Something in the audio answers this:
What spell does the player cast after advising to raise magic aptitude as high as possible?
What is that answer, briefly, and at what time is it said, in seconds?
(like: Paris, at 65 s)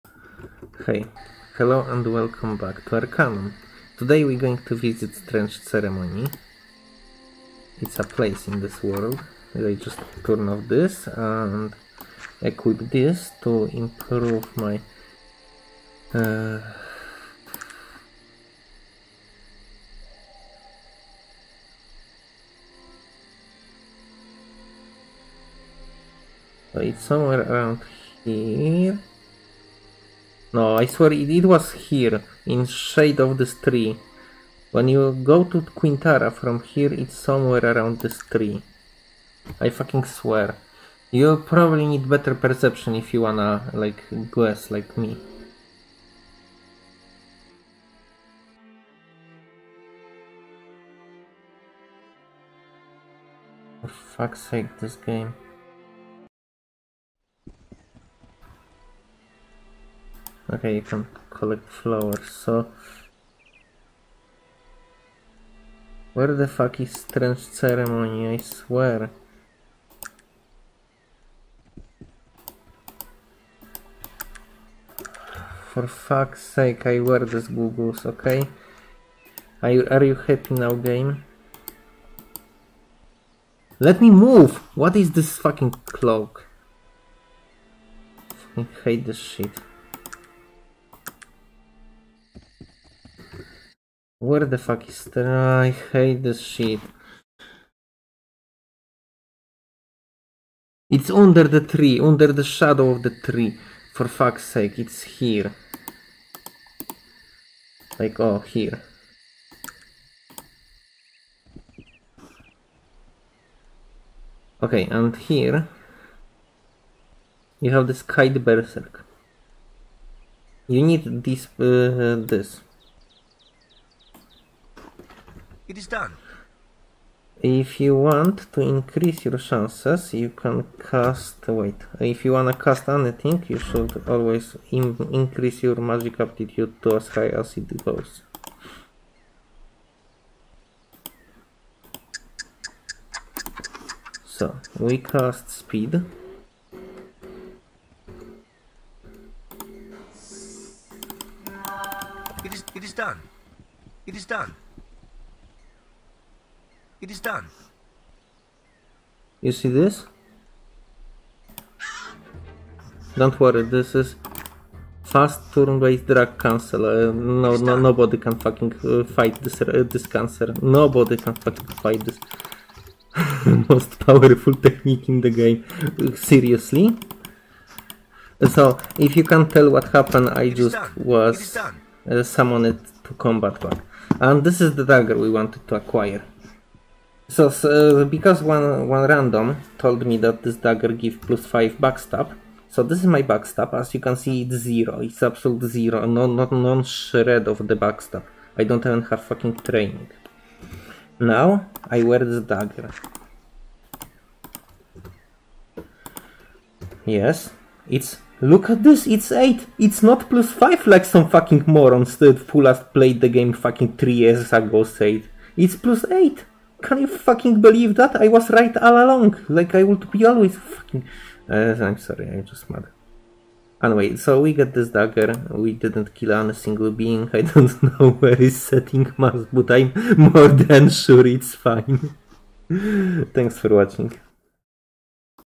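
speed, at 145 s.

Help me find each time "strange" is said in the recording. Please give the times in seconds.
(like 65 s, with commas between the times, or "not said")
5 s, 66 s.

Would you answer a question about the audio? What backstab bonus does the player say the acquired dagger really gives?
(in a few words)
plus 8.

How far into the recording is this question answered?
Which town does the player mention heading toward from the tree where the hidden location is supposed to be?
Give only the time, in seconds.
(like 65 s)
35 s.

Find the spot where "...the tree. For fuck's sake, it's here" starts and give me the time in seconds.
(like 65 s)
103 s.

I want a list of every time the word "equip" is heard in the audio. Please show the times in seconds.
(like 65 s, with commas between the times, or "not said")
12 s.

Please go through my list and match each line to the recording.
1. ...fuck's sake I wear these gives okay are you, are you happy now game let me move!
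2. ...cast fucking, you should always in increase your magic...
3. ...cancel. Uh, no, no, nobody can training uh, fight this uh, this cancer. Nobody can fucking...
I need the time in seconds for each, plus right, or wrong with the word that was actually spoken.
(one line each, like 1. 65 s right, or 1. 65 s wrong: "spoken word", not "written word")
1. 75 s wrong: "googles", not "gives"
2. 132 s wrong: "anything", not "fucking"
3. 166 s wrong: "fucking", not "training".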